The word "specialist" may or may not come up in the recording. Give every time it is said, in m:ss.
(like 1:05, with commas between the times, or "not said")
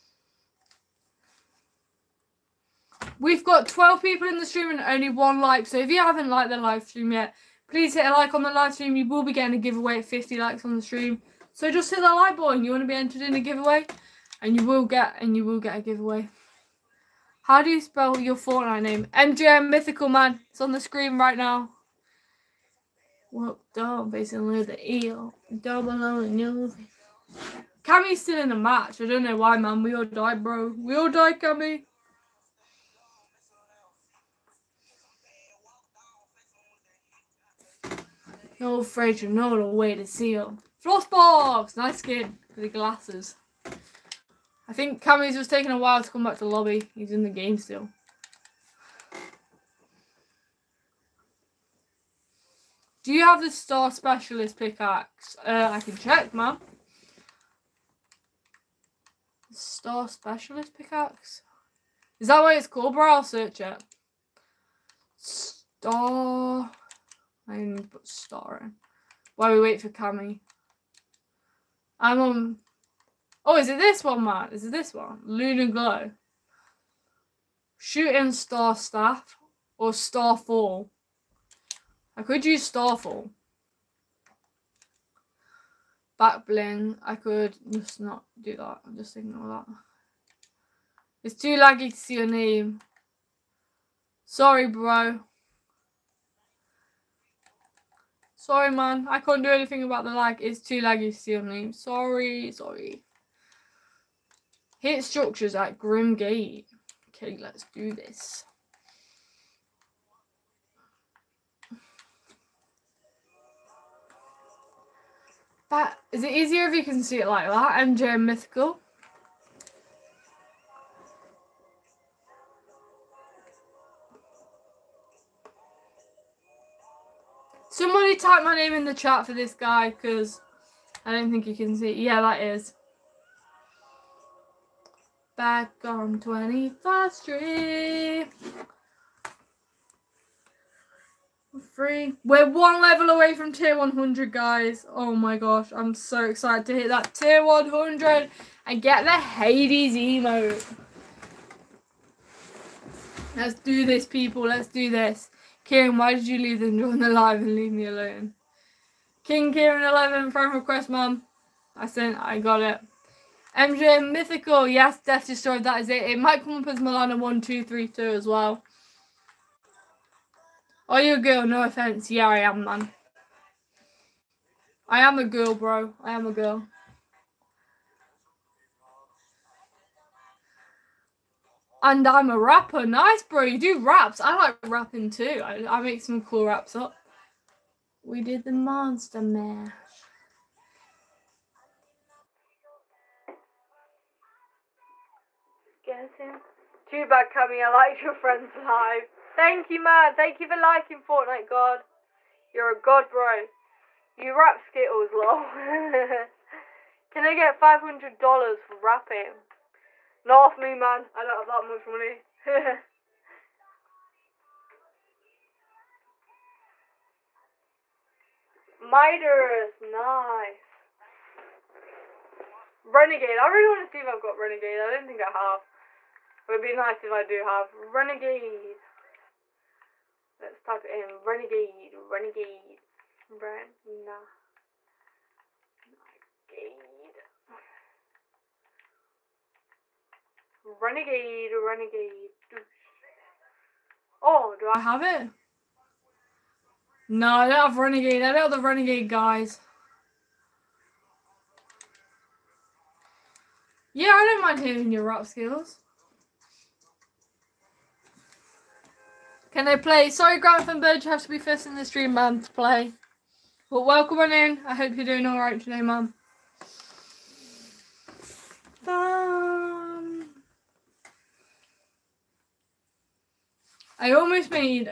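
0:53, 1:00.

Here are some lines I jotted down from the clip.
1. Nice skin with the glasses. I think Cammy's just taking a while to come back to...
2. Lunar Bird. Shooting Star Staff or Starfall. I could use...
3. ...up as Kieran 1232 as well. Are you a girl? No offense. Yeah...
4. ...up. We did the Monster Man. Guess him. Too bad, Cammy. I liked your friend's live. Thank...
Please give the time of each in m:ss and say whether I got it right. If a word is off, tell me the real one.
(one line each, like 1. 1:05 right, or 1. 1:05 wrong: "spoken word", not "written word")
1. 0:41 right
2. 1:15 wrong: "Glow", not "Bird"
3. 2:46 wrong: "Milana", not "Kieran"
4. 3:06 right.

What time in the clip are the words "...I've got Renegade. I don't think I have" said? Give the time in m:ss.
3:44.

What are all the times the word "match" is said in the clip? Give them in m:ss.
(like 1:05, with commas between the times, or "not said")
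0:28.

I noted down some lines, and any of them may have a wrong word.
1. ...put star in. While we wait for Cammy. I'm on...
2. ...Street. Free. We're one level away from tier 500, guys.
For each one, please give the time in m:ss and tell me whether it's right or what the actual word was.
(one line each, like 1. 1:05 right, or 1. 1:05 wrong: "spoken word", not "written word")
1. 1:07 right
2. 2:17 wrong: "100", not "500".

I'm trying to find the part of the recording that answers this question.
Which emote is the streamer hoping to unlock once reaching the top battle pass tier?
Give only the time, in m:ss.
2:29.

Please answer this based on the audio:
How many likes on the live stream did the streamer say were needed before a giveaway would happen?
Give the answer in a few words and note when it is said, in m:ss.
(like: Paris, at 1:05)
50, at 0:10.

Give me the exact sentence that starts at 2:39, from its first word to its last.
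King Kieran 11 friend request, mum.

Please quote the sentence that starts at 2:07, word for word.
Somebody type my name in the chat for this guy because I don't think you can see.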